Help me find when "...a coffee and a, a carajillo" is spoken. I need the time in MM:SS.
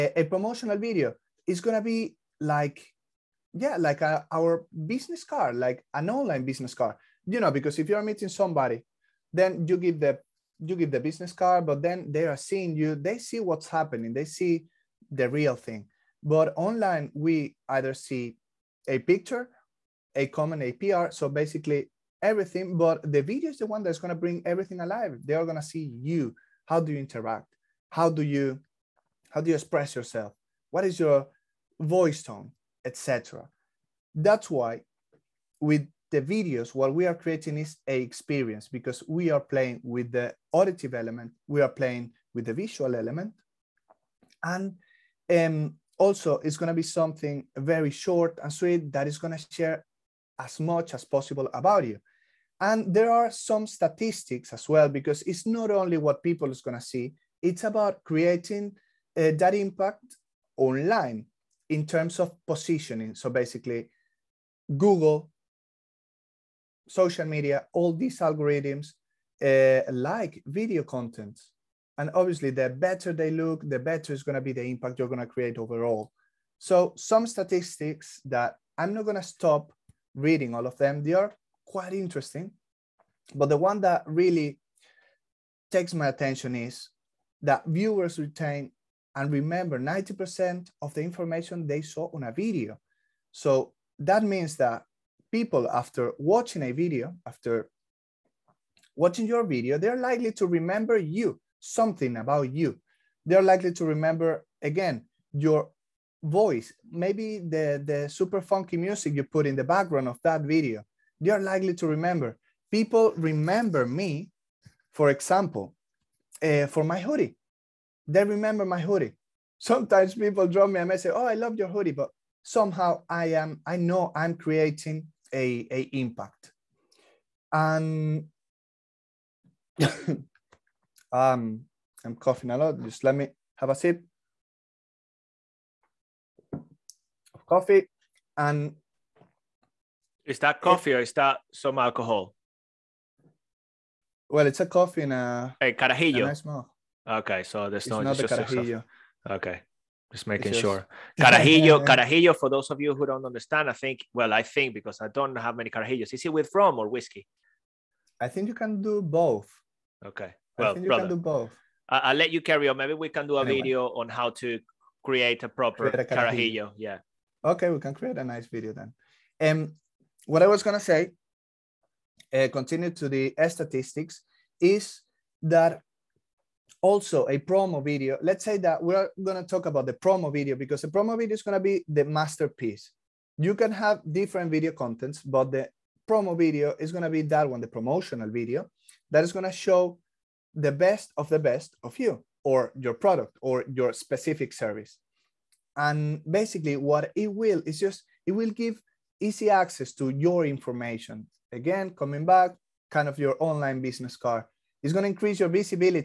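02:24.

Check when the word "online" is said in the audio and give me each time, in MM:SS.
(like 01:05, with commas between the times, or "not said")
00:06, 00:16, 01:00, 03:23.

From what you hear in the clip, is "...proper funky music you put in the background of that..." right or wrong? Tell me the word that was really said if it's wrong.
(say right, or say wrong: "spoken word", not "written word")
wrong: "super", not "proper".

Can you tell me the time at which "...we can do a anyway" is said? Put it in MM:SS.
02:42.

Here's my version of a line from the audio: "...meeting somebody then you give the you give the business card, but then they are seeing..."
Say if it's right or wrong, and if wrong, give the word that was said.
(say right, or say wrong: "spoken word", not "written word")
right.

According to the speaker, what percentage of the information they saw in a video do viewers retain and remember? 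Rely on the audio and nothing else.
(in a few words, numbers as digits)
90%.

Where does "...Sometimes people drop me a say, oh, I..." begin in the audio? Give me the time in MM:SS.
01:59.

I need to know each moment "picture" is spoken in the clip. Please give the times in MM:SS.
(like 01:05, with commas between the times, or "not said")
00:18.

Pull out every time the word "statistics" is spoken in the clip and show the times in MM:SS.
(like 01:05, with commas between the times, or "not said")
00:53, 01:17, 02:53.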